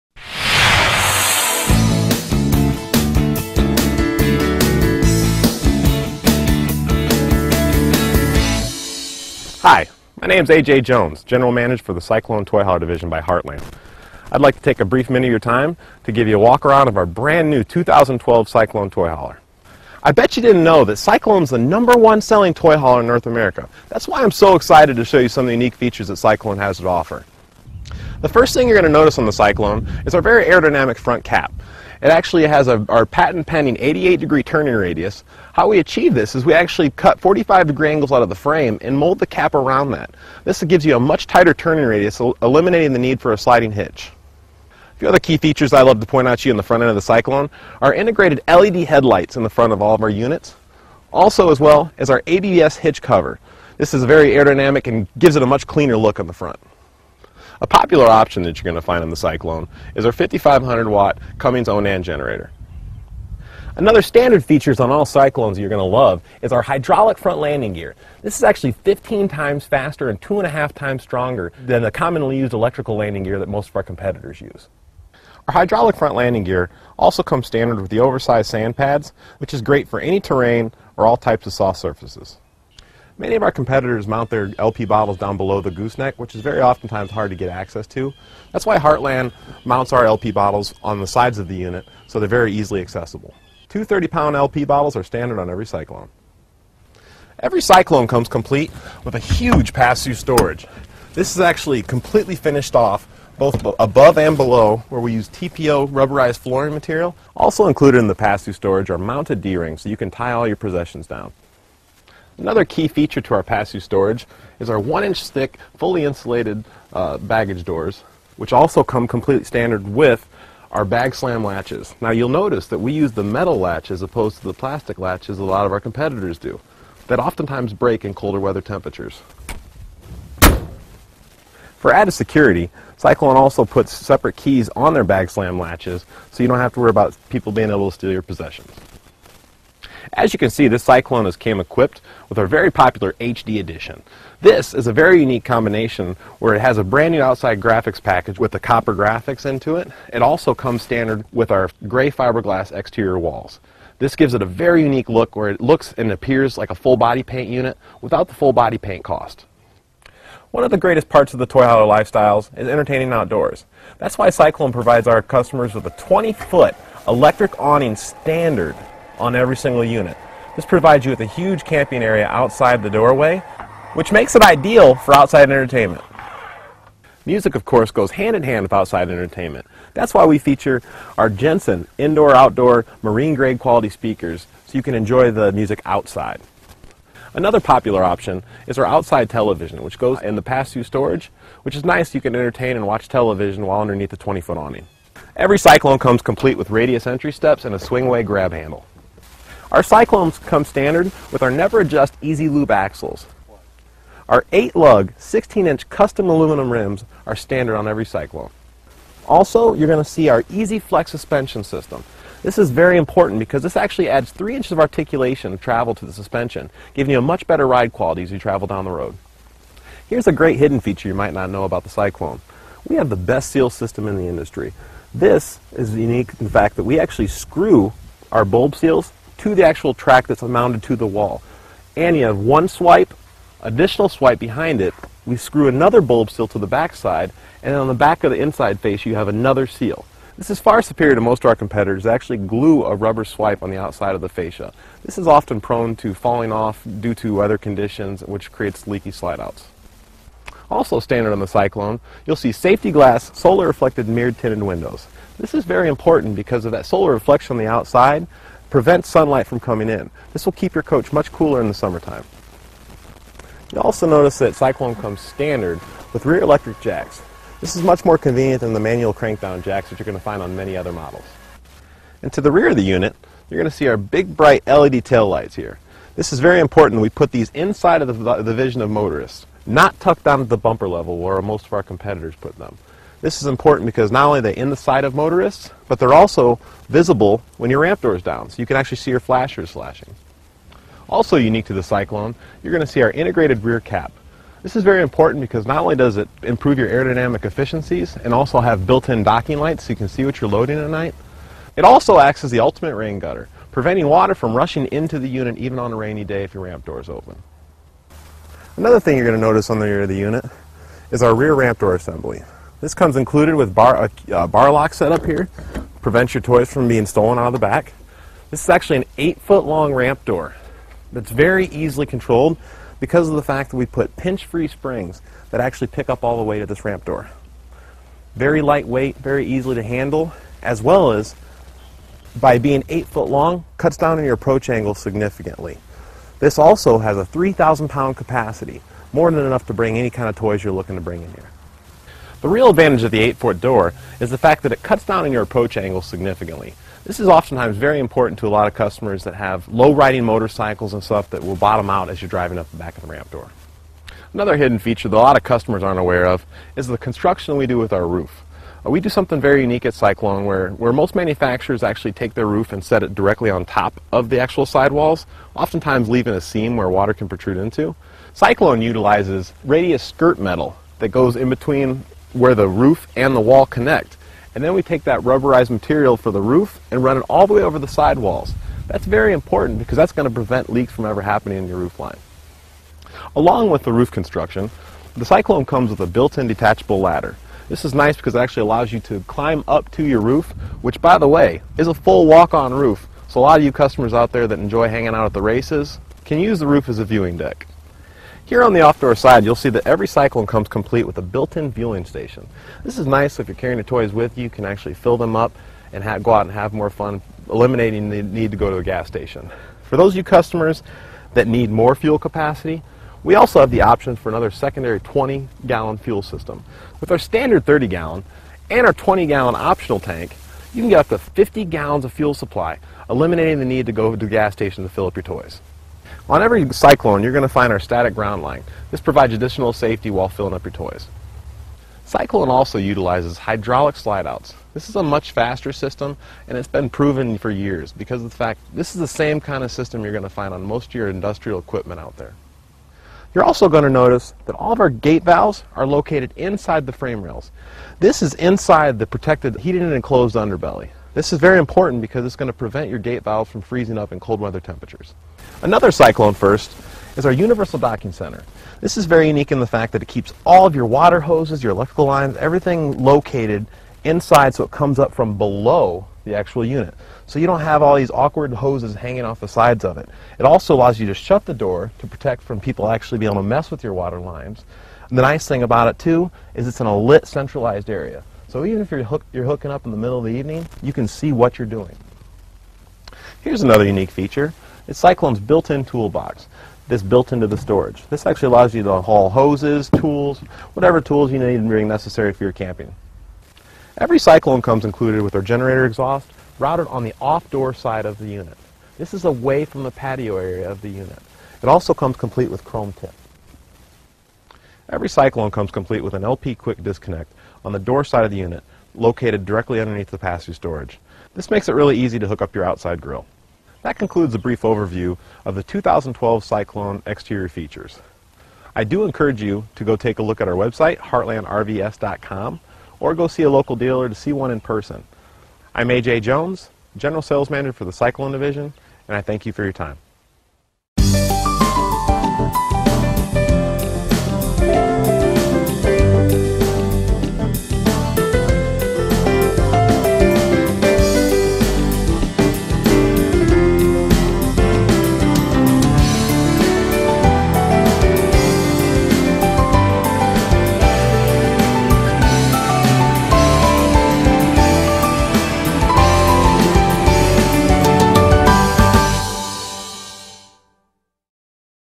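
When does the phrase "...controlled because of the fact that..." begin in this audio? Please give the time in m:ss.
5:22.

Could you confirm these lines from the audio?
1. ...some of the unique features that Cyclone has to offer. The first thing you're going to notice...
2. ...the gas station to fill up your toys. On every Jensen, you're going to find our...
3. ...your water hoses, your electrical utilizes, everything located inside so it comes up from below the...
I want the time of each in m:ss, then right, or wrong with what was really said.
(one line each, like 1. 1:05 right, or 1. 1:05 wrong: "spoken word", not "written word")
1. 0:25 right
2. 7:04 wrong: "Cyclone", not "Jensen"
3. 7:40 wrong: "lines", not "utilizes".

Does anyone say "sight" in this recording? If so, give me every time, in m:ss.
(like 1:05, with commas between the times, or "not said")
4:44.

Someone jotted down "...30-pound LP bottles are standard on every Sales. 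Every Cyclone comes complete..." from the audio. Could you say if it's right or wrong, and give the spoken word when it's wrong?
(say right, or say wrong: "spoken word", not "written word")
wrong: "Cyclone", not "Sales".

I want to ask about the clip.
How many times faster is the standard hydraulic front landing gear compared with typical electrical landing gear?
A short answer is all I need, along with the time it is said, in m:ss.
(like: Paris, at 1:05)
15 times, at 1:08.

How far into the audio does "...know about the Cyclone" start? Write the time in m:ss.
3:41.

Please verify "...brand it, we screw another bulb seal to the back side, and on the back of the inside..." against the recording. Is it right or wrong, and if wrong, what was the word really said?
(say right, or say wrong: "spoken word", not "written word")
wrong: "behind", not "brand".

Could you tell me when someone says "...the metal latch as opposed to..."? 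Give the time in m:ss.
2:03.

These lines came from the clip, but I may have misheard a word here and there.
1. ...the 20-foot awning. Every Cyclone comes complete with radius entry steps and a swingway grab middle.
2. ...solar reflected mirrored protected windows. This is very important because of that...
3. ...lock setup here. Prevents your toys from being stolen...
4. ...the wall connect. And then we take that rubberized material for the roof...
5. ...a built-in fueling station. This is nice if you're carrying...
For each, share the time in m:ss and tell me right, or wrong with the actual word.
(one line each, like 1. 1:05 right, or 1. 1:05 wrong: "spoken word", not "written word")
1. 3:14 wrong: "handle", not "middle"
2. 4:13 wrong: "tinted", not "protected"
3. 5:14 right
4. 6:13 right
5. 6:41 right.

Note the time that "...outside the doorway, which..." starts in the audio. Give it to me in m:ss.
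2:52.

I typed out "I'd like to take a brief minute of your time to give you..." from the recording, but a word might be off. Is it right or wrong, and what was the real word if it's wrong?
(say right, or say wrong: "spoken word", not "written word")
right.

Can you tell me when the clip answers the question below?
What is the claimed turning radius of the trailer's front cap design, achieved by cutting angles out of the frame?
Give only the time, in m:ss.
0:33.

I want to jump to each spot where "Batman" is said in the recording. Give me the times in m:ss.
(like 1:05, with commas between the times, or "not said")
not said.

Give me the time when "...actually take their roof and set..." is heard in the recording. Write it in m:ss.
6:01.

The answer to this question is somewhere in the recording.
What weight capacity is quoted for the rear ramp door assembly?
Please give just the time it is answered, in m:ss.
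5:37.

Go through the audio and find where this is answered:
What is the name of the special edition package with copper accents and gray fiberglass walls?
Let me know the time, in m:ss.
2:23.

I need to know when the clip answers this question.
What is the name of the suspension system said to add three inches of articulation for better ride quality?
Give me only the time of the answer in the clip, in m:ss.
3:30.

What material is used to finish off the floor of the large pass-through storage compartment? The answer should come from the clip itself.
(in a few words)
TPO rubberized flooring.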